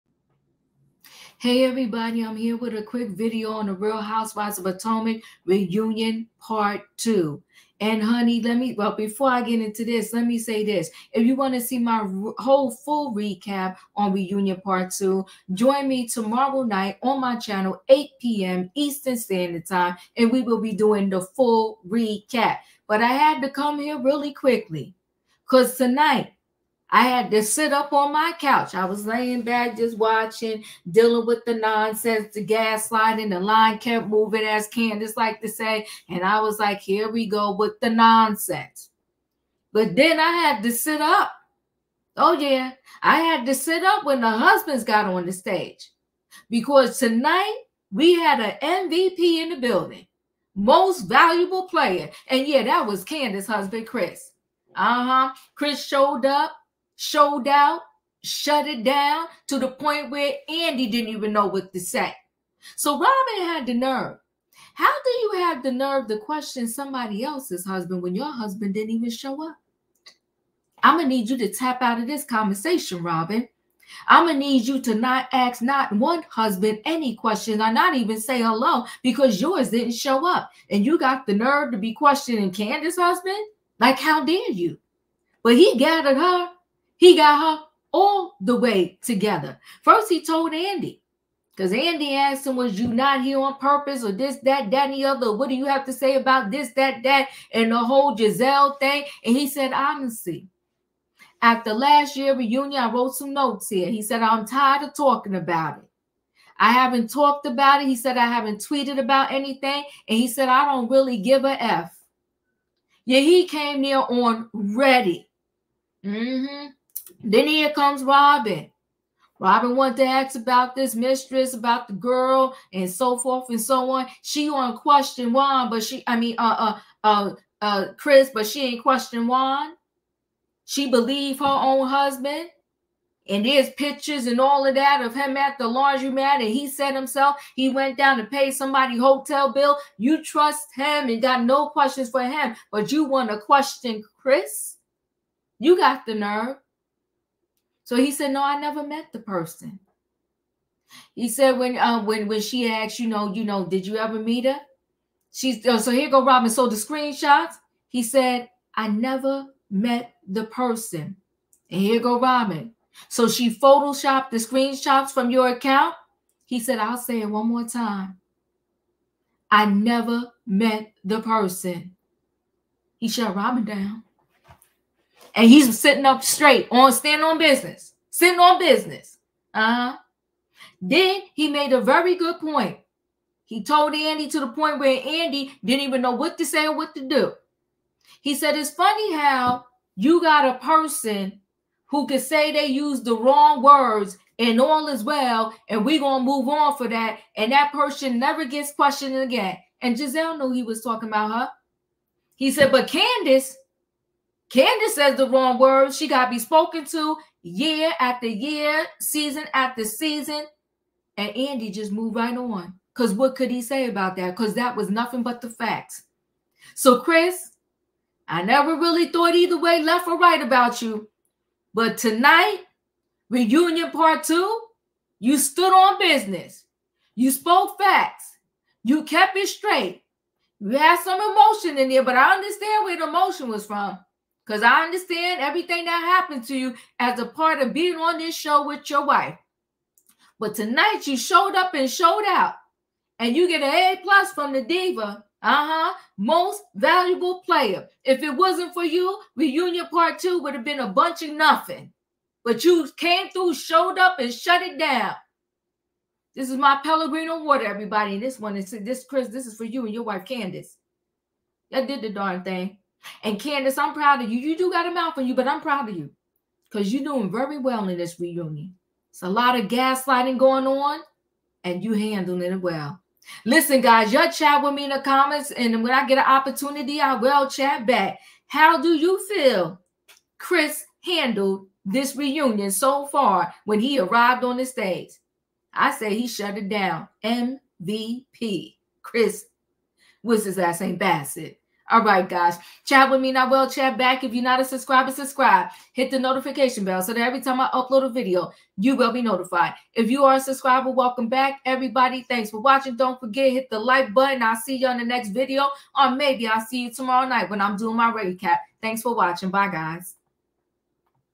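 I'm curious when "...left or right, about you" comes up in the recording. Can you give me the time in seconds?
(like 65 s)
219 s.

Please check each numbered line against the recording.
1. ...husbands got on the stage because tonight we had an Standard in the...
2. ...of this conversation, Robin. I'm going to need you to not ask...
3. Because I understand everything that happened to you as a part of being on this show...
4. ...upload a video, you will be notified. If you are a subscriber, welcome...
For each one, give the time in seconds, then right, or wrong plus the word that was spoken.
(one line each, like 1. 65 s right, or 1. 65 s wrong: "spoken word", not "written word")
1. 44 s wrong: "MVP", not "Standard"
2. 71 s right
3. 234 s right
4. 297 s right.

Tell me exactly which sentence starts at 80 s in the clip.
And you got the nerve to be questioning Candace's husband?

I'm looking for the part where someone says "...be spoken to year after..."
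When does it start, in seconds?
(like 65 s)
206 s.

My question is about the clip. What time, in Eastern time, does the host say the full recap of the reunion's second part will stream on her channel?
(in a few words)
8 p.m.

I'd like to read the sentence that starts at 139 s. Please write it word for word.
You trust him and got no questions for him, but you want to question Chris?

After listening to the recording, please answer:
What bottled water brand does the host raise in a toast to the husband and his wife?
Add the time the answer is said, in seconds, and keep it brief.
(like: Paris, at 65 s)
Pellegrino, at 256 s.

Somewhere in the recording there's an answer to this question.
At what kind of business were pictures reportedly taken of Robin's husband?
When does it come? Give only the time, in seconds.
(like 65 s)
135 s.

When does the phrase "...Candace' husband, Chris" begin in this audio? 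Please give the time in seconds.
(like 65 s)
53 s.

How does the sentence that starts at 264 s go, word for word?
You do got a mouth on you, but I'm proud of you because you're doing very well in this reunion.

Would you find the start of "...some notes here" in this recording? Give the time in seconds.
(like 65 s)
103 s.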